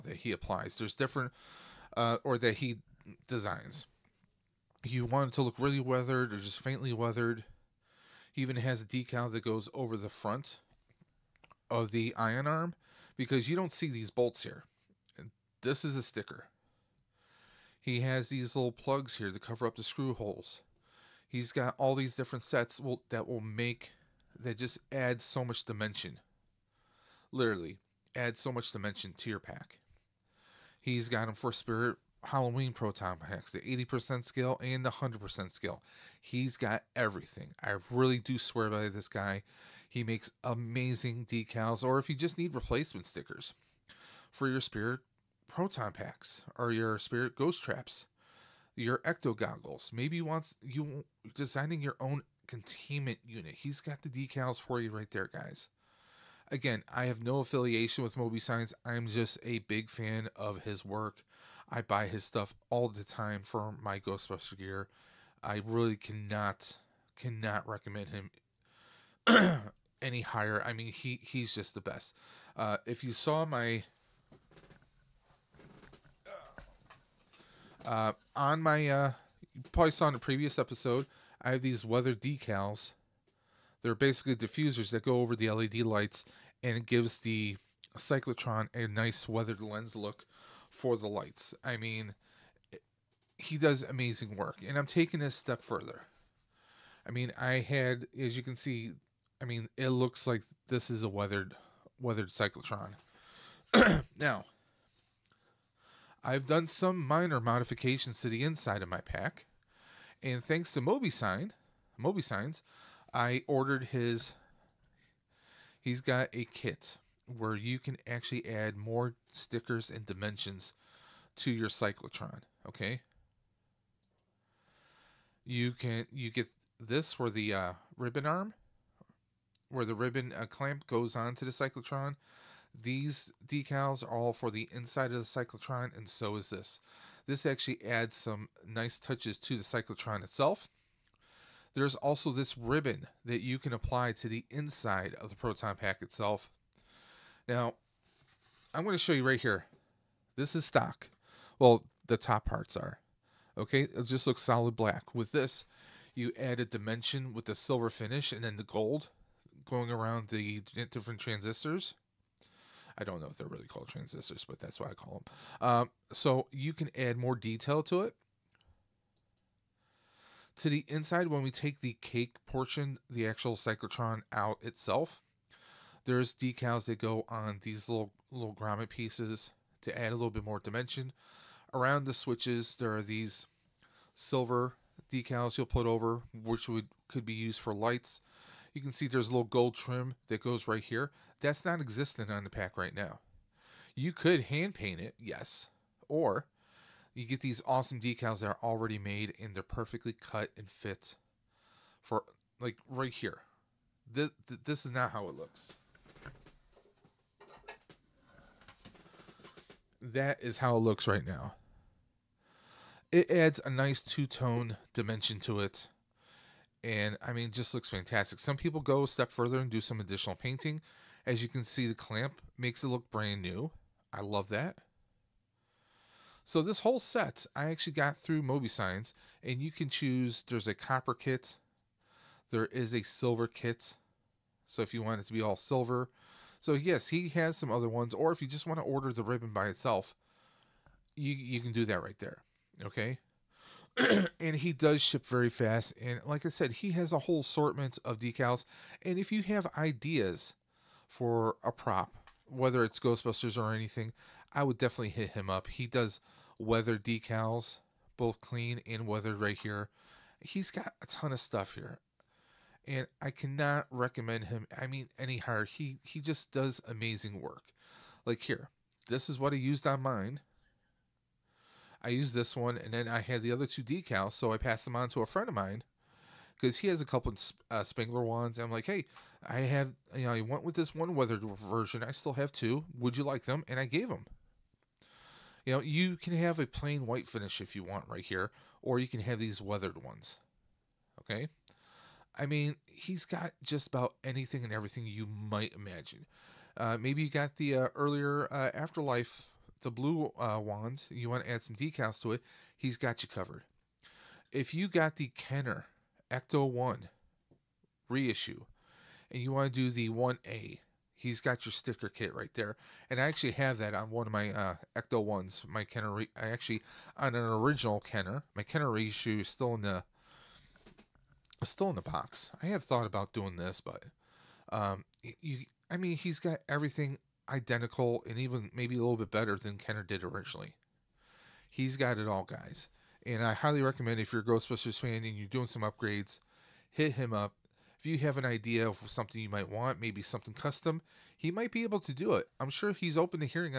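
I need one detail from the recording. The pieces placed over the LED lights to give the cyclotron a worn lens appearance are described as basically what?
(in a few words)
Diffusers.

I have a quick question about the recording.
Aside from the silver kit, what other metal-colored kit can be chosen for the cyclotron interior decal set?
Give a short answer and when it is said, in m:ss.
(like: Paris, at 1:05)
Copper kit, at 3:50.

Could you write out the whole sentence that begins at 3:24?
This, this is not how it looks.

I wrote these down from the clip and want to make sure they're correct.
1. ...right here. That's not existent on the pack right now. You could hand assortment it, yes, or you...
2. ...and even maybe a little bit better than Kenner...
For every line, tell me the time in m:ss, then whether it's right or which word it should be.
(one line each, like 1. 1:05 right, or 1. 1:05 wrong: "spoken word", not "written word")
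1. 3:10 wrong: "paint", not "assortment"
2. 5:28 right.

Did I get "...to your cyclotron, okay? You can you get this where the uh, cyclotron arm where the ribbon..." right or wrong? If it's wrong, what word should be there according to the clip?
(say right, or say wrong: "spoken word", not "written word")
wrong: "ribbon", not "cyclotron".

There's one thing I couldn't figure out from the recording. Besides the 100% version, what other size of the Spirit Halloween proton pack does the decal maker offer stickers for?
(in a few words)
80% scale.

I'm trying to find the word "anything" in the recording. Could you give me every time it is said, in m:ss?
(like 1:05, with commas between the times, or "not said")
4:13, 4:54.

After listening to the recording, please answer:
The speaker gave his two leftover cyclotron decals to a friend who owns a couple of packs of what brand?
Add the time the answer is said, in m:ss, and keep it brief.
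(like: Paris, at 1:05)
Spangler, at 4:37.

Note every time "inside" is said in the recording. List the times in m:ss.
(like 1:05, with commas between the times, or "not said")
1:48, 2:14, 2:24, 2:50.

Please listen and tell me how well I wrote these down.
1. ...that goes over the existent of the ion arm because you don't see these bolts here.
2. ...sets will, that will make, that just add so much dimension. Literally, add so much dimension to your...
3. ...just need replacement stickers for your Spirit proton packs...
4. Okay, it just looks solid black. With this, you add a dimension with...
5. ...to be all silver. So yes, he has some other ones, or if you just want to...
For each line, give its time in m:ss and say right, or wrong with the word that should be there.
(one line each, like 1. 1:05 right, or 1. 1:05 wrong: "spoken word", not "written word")
1. 0:09 wrong: "front", not "existent"
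2. 0:22 right
3. 0:42 right
4. 2:33 right
5. 3:55 right.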